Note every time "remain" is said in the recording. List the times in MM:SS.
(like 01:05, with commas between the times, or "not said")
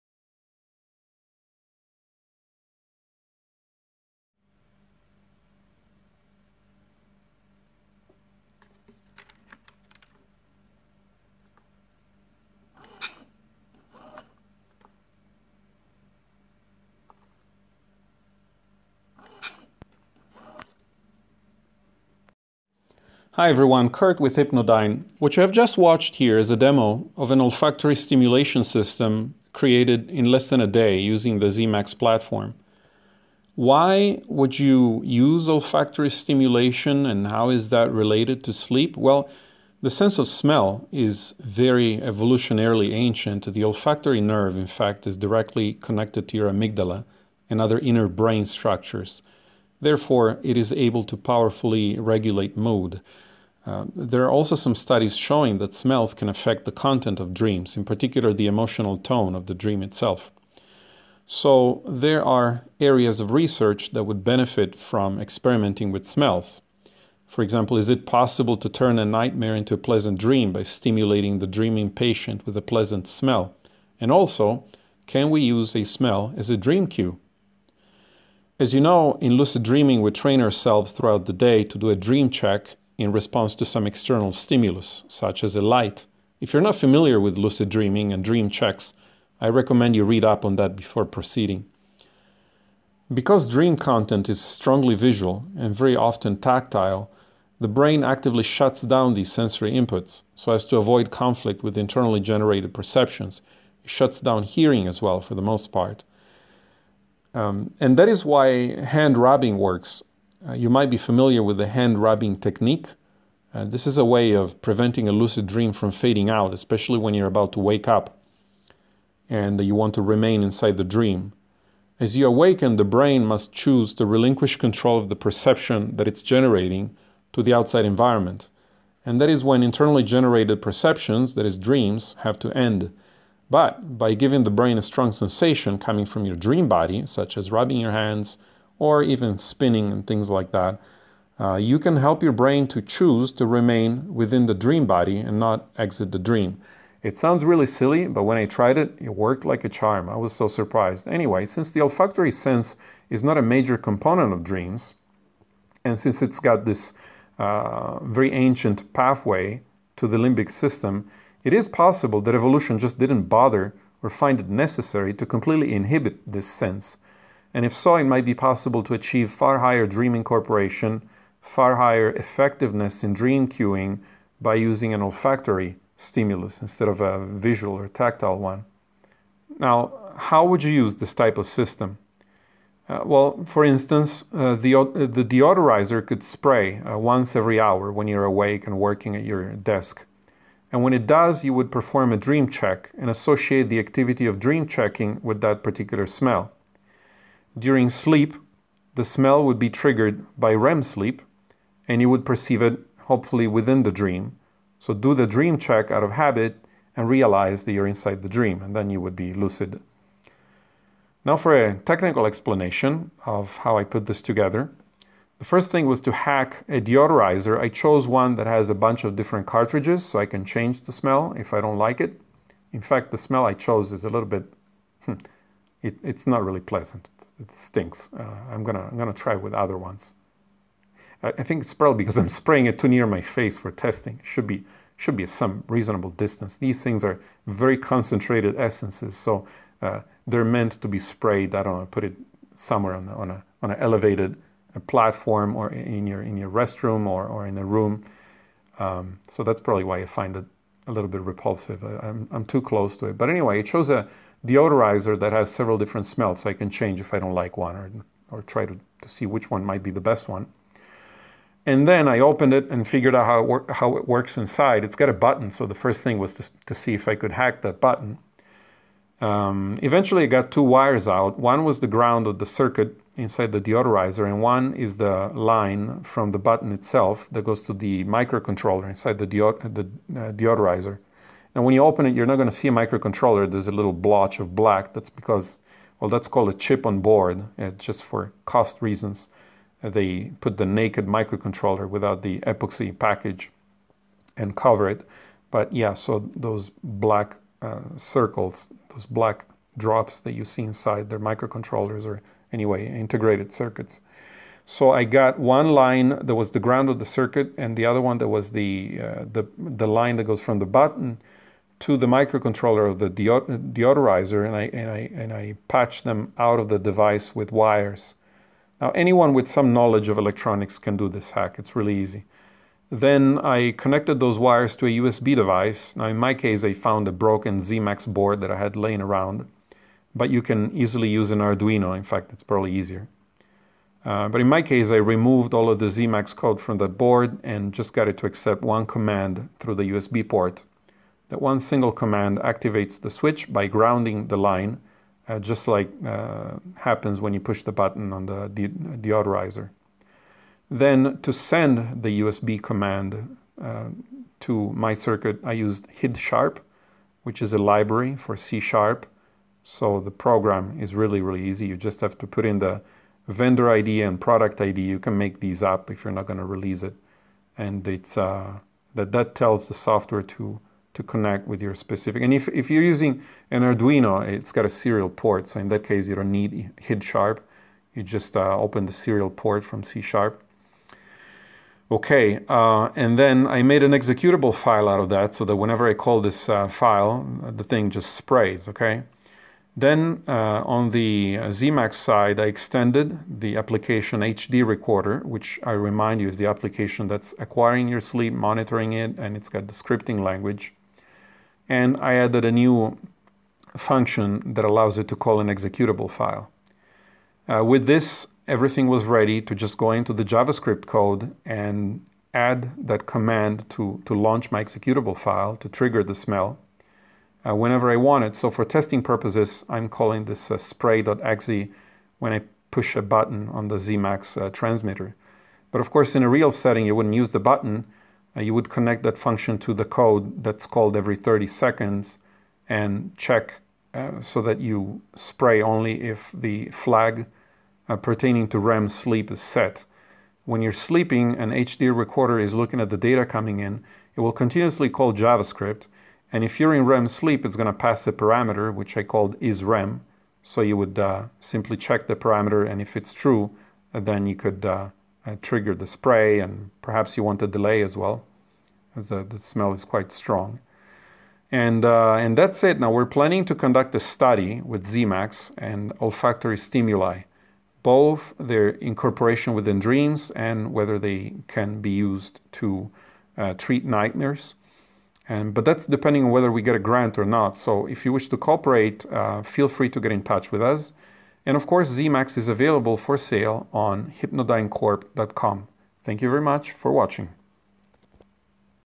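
02:00, 02:23.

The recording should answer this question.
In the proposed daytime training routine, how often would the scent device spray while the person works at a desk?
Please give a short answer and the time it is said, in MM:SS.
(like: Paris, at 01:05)
once every hour, at 03:06.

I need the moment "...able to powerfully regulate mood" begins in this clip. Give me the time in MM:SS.
00:50.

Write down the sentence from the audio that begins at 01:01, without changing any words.
So there are areas of research that would benefit from experimenting with smells.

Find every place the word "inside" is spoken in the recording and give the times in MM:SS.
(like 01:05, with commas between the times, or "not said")
02:00, 03:27, 04:24, 04:33, 04:38, 05:00.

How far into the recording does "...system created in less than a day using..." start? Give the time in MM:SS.
00:28.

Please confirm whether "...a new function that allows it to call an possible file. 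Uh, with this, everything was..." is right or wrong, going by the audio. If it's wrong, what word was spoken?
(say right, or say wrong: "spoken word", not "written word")
wrong: "executable", not "possible".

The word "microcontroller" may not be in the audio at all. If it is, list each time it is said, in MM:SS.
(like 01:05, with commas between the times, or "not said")
04:38, 04:42, 04:51, 05:01, 05:12.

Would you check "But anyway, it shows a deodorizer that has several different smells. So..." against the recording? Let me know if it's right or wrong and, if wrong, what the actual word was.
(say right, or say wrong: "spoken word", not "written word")
right.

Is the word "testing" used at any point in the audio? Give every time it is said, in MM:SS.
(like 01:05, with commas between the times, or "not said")
03:53, 06:58.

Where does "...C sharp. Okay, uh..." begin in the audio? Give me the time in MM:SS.
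06:19.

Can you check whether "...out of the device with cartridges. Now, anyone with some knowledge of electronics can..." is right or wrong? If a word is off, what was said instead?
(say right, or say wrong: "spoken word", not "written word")
wrong: "wires", not "cartridges".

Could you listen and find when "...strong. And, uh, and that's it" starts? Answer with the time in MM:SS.
07:40.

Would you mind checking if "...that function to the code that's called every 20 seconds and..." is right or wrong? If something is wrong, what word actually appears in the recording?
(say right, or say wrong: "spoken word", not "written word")
wrong: "30", not "20".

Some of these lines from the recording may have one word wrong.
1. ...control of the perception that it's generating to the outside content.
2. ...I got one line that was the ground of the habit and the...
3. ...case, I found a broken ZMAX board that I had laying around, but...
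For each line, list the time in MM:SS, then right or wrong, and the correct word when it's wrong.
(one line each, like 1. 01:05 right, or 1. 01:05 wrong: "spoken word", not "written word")
1. 02:04 wrong: "environment", not "content"
2. 05:04 wrong: "circuit", not "habit"
3. 05:26 right.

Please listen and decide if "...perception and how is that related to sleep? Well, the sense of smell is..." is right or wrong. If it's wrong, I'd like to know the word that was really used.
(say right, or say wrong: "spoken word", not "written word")
wrong: "stimulation", not "perception".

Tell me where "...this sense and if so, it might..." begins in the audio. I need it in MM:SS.
02:46.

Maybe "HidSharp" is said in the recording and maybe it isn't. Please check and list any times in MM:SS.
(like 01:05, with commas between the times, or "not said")
05:56, 06:16.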